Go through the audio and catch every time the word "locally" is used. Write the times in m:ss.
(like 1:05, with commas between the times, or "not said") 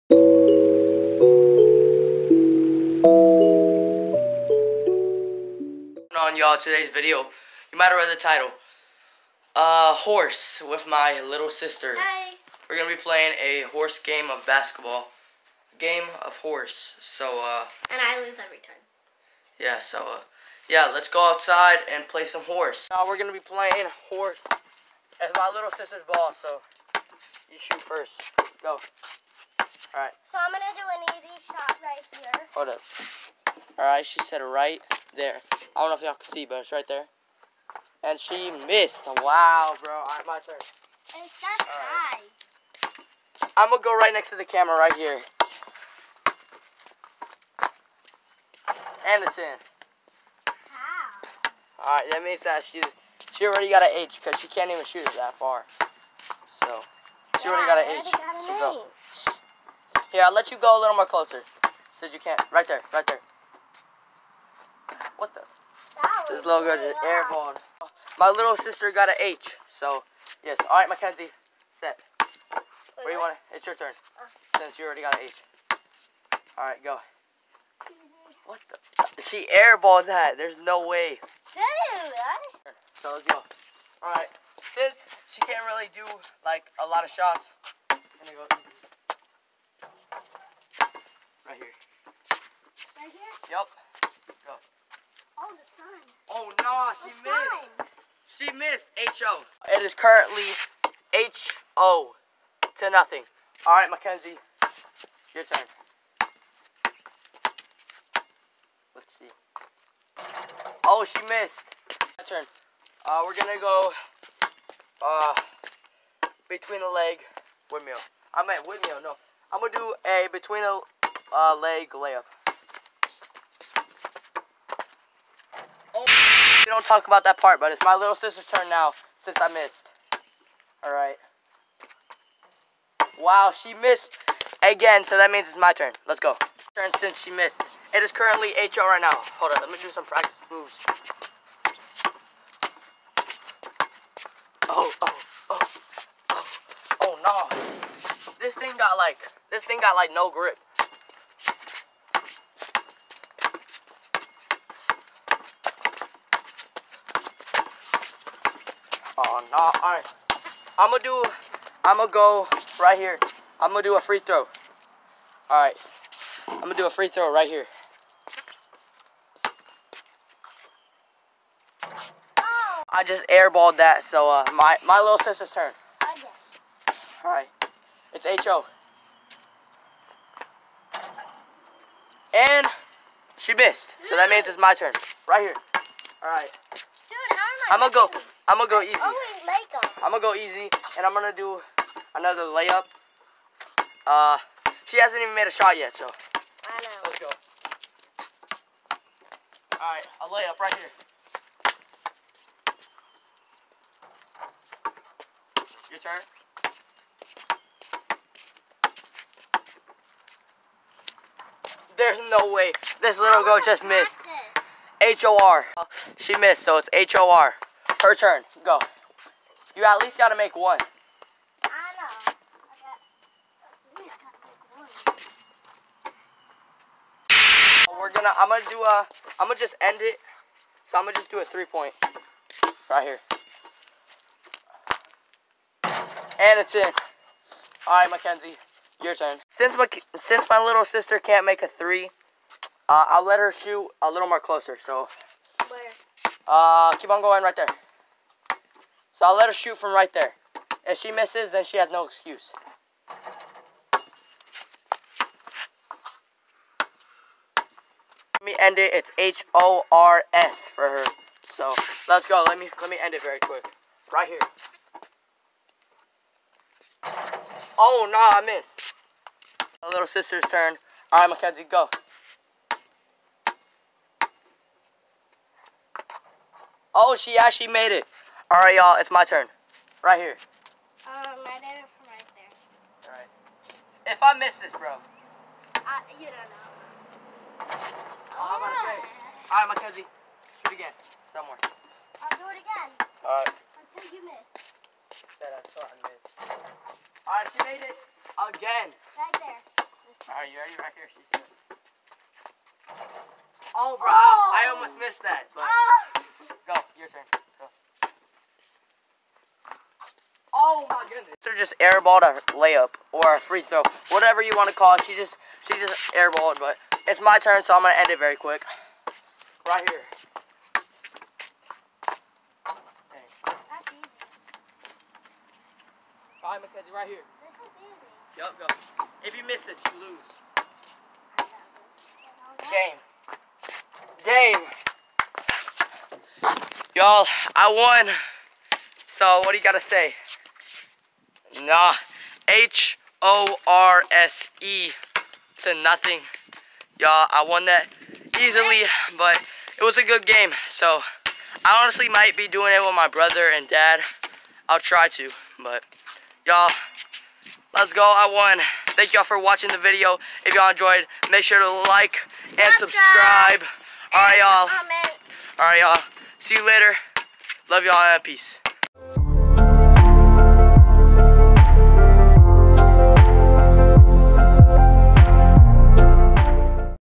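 not said.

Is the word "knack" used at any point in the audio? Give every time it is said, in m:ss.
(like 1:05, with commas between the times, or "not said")
not said.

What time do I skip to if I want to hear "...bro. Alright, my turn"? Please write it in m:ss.
0:39.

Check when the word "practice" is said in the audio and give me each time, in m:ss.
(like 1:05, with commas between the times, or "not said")
2:20.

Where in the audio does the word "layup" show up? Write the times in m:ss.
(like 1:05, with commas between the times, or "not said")
2:01, 3:12, 3:20, 5:12.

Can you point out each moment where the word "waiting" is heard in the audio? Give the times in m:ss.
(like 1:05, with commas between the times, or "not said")
not said.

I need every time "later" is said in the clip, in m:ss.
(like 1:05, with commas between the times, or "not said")
6:06.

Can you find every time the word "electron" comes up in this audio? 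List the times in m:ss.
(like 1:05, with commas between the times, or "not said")
not said.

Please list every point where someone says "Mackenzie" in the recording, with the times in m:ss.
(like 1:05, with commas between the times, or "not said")
1:10, 1:43, 3:58, 4:31, 5:26.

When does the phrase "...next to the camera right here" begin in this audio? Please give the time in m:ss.
0:44.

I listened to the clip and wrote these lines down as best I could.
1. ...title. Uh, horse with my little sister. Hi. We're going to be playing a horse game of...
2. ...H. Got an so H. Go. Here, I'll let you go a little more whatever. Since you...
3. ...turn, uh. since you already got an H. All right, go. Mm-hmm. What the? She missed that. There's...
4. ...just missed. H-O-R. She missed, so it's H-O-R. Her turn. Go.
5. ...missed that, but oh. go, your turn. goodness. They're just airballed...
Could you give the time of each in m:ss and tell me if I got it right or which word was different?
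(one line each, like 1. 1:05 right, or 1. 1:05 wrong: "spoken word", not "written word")
1. 0:08 right
2. 0:58 wrong: "closer", not "whatever"
3. 1:13 wrong: "airballed", not "missed"
4. 3:33 right
5. 5:04 right.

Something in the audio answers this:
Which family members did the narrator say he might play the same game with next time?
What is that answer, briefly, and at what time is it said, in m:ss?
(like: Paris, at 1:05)
brother and dad, at 5:53.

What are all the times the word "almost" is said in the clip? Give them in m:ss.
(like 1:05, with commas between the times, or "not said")
5:04.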